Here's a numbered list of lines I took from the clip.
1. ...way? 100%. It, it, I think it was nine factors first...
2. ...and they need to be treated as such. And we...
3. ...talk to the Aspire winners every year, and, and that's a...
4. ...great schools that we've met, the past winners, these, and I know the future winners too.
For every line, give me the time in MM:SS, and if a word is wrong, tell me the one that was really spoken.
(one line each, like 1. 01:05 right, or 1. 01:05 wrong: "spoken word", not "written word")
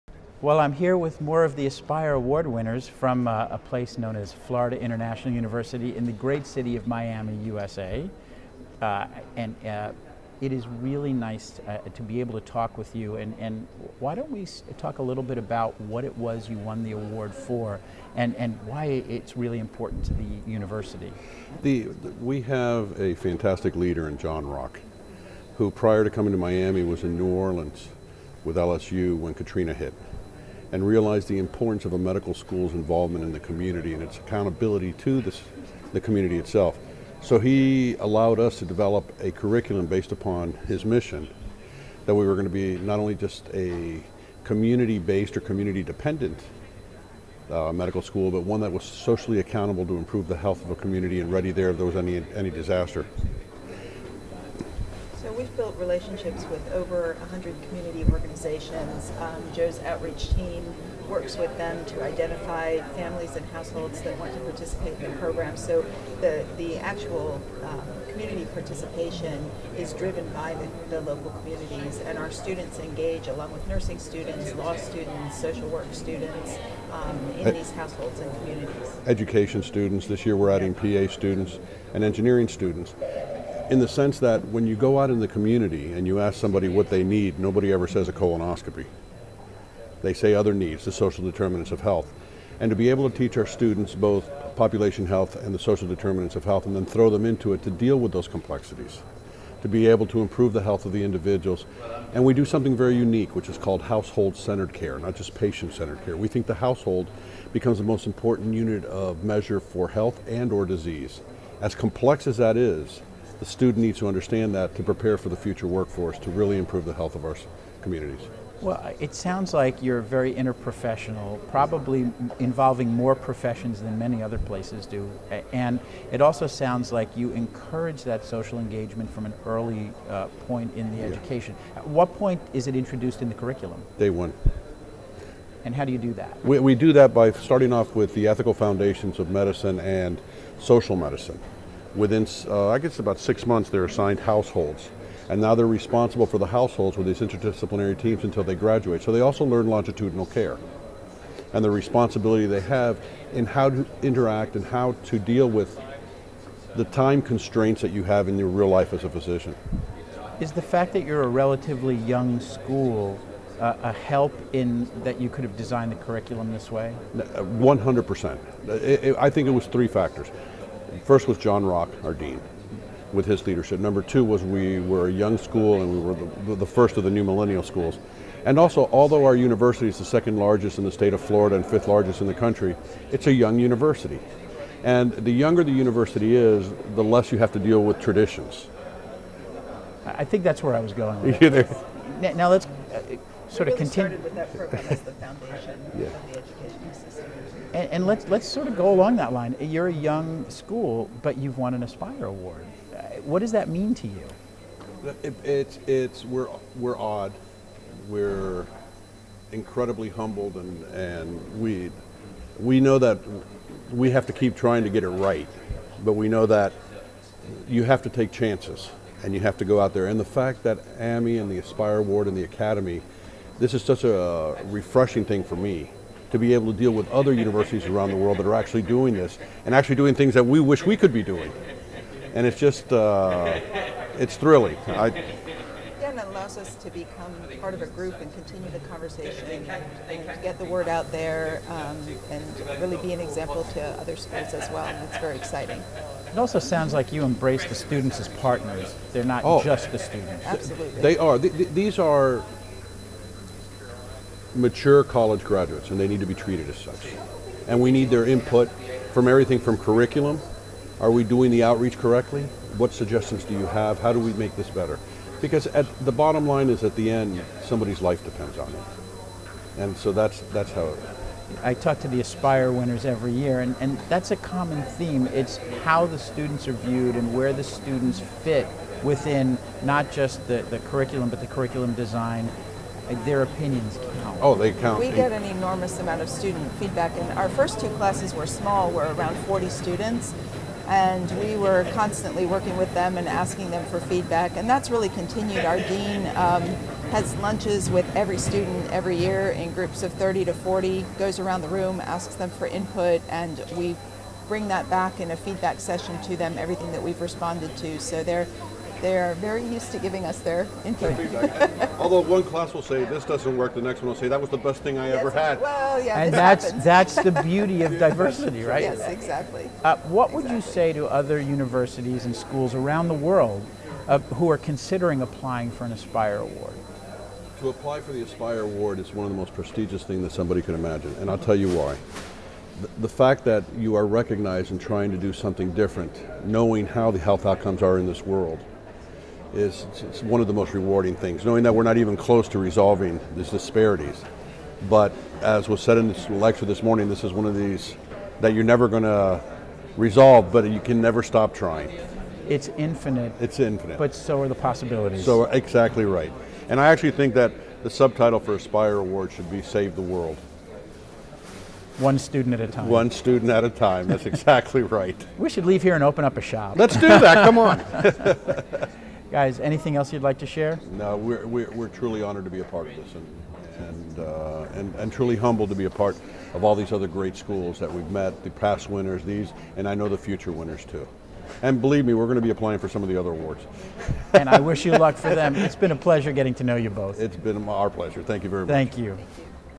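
1. 02:46 wrong: "three", not "nine"
2. 04:15 right
3. 04:31 right
4. 06:17 right.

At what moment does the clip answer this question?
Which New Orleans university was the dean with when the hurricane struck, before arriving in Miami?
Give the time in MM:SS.
00:28.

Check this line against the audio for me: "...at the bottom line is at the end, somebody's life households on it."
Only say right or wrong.
wrong.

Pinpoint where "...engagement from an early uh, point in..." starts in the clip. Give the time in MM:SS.
02:08.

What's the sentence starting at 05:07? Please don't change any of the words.
So they're they're very used to giving us their input.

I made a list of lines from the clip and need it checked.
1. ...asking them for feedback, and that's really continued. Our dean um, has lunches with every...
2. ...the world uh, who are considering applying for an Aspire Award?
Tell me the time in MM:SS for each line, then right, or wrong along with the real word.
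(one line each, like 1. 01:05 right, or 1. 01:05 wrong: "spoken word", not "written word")
1. 04:53 right
2. 05:23 right.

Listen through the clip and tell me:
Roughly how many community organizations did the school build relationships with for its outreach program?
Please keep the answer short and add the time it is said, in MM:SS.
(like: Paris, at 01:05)
over 100, at 00:56.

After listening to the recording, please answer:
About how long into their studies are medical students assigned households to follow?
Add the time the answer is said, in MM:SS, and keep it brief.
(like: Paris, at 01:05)
about six months, at 02:22.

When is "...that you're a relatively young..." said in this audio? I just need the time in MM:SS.
02:40.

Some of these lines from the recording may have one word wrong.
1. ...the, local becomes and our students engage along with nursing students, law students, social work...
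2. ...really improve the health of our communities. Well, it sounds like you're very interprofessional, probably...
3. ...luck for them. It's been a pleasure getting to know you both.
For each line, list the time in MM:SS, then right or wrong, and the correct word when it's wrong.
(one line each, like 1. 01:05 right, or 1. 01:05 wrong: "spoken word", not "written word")
1. 01:10 wrong: "communities", not "becomes"
2. 01:56 right
3. 06:24 right.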